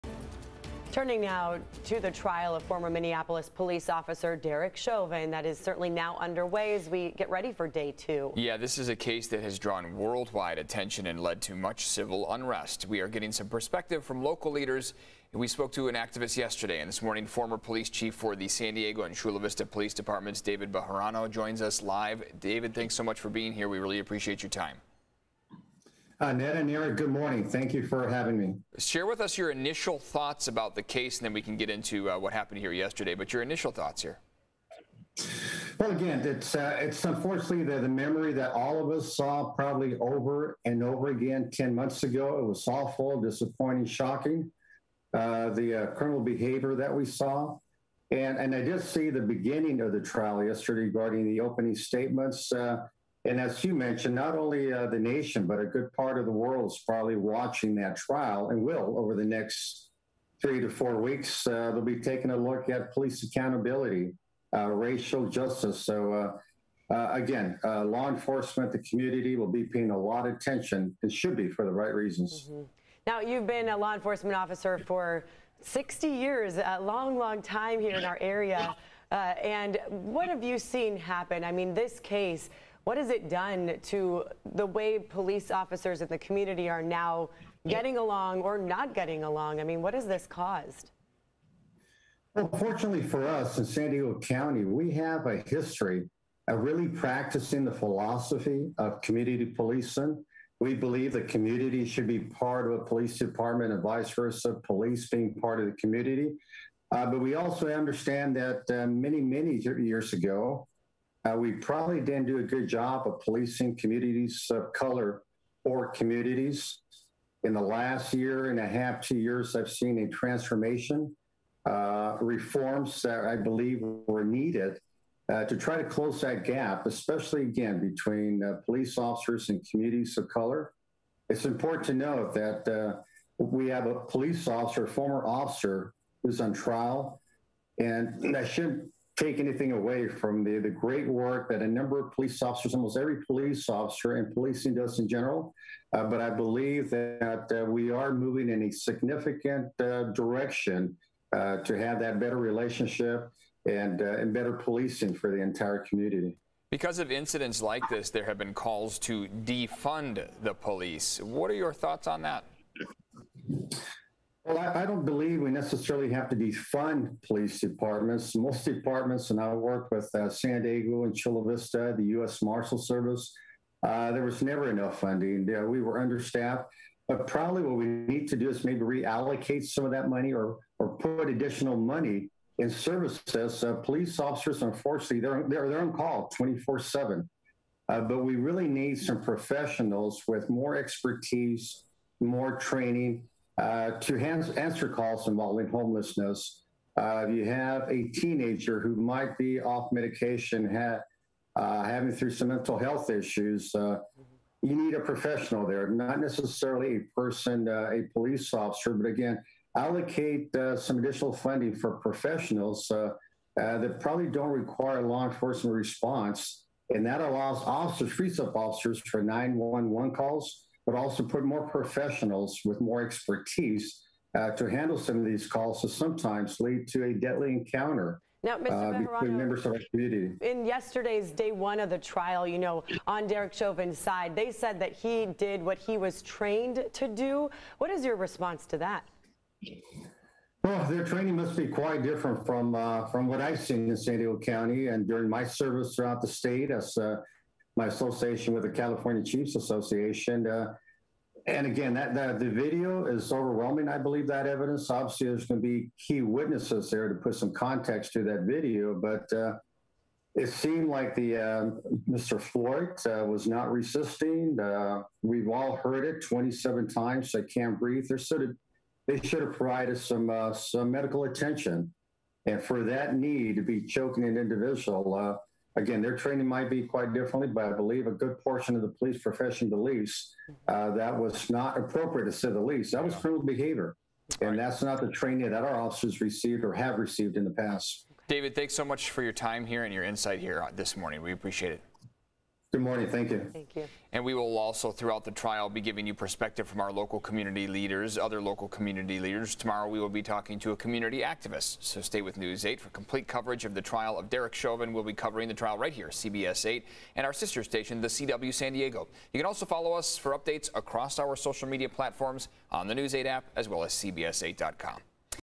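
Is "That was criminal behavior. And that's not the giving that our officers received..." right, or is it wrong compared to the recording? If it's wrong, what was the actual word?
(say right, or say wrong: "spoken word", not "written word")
wrong: "training", not "giving".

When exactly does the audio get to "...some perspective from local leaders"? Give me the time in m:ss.
0:13.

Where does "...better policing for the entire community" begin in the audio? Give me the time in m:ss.
2:34.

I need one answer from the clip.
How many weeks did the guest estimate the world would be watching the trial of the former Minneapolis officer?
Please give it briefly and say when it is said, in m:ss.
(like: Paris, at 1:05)
3 to 4 weeks, at 1:00.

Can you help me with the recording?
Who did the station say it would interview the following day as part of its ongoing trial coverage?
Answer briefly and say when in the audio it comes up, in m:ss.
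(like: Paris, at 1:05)
A community activist, at 5:00.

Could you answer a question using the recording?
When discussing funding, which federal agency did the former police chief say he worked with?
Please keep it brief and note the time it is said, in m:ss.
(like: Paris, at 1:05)
U.S. Marshal Service, at 2:52.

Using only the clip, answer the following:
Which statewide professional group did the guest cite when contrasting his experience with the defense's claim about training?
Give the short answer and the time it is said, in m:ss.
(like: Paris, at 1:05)
California Chiefs Association, at 4:08.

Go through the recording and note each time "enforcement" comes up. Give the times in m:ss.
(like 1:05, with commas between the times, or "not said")
1:08, 1:13, 3:35.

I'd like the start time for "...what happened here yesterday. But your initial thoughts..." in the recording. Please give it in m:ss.
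0:32.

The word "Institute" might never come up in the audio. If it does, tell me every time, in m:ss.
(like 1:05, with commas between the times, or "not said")
not said.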